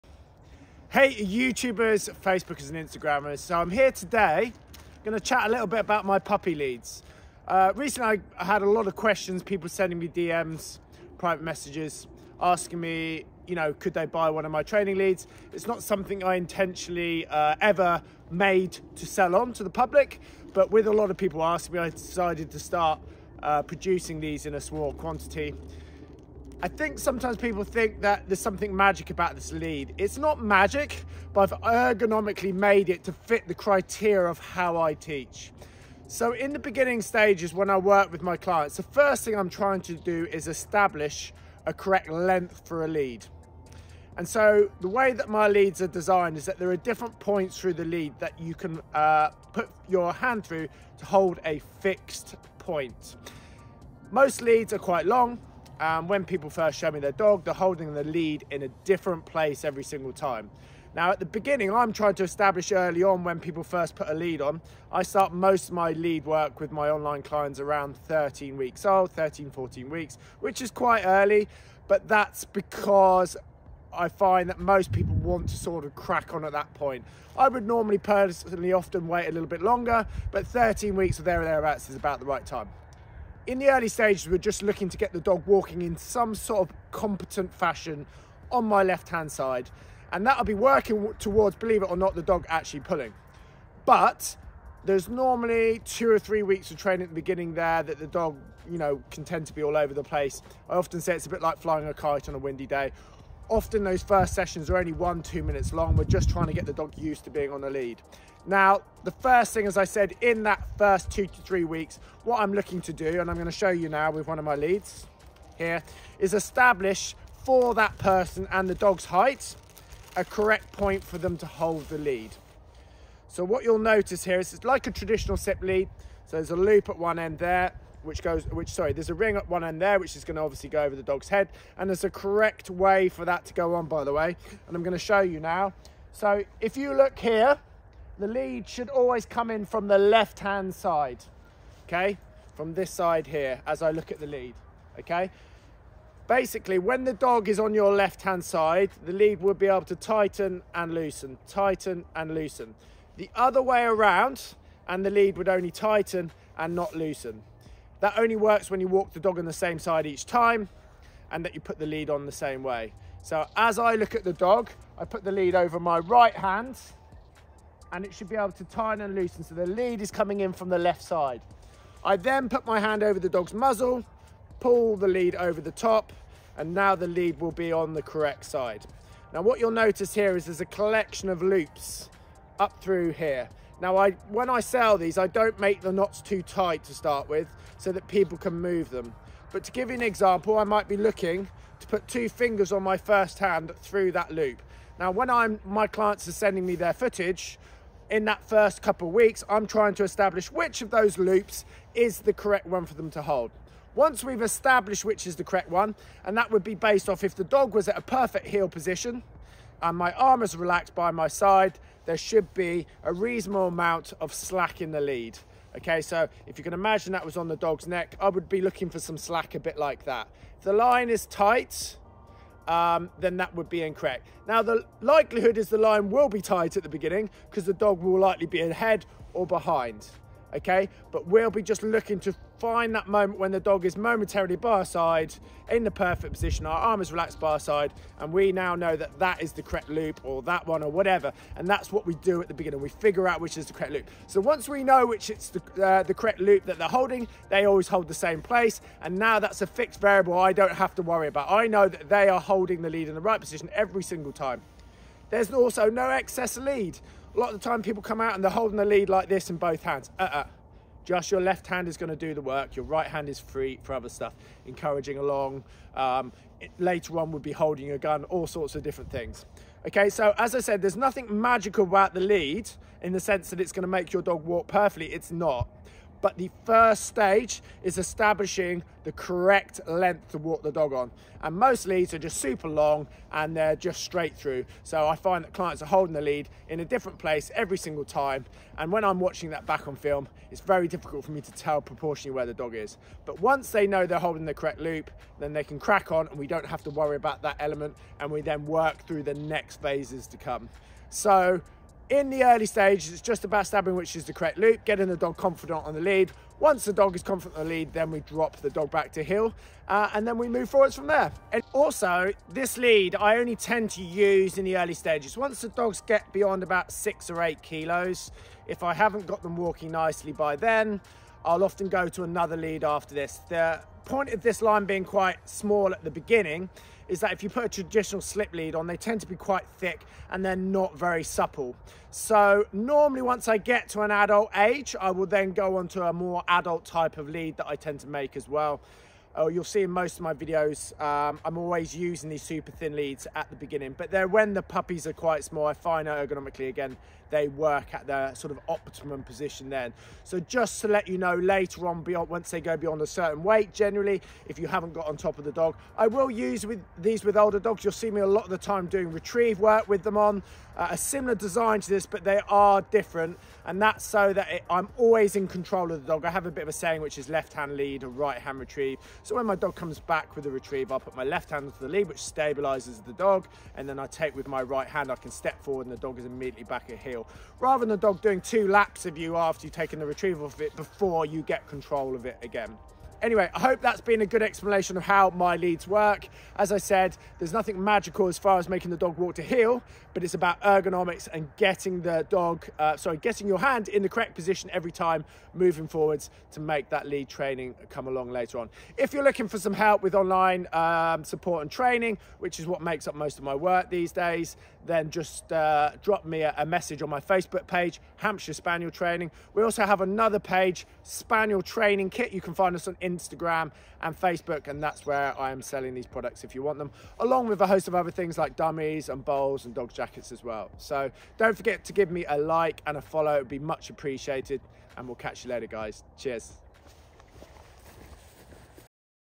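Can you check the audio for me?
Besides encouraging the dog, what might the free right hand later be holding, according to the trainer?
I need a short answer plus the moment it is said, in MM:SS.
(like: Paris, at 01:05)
A gun, at 04:27.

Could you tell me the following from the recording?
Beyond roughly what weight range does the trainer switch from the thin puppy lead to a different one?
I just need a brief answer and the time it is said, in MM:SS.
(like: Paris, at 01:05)
6 or 8 kilos, at 05:16.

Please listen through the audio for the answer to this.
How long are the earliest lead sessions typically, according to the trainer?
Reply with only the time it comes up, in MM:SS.
01:44.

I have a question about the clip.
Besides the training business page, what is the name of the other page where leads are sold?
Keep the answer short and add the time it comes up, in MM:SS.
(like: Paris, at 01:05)
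Spaniel Training Kit, at 06:51.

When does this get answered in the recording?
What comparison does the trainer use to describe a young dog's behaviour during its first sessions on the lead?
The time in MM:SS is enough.
01:41.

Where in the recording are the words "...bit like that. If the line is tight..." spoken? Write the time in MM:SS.
03:39.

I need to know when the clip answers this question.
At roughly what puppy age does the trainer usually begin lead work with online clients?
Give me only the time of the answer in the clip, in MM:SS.
01:07.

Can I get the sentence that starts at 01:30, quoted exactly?
And that'll be working towards, believe it or not, the dog actually pulling.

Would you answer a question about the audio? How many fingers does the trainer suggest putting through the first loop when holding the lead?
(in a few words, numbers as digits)
2.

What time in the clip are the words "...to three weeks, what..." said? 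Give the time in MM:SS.
01:51.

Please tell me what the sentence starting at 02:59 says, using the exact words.
Now what you'll notice here is there's a collection of loops up through here.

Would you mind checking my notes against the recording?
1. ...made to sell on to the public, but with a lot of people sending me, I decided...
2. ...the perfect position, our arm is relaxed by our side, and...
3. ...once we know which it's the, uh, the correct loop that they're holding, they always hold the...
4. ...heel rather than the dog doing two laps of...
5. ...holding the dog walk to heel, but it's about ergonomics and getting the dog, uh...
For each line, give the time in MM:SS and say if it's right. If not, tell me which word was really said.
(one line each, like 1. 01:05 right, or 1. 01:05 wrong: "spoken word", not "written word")
1. 00:18 wrong: "asking", not "sending"
2. 03:55 right
3. 04:04 right
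4. 06:16 right
5. 06:28 wrong: "making", not "holding".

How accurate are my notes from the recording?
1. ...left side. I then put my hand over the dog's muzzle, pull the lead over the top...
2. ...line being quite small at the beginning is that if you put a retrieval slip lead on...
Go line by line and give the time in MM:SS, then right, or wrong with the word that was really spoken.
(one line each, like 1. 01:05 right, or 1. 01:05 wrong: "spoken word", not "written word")
1. 02:50 right
2. 05:24 wrong: "traditional", not "retrieval".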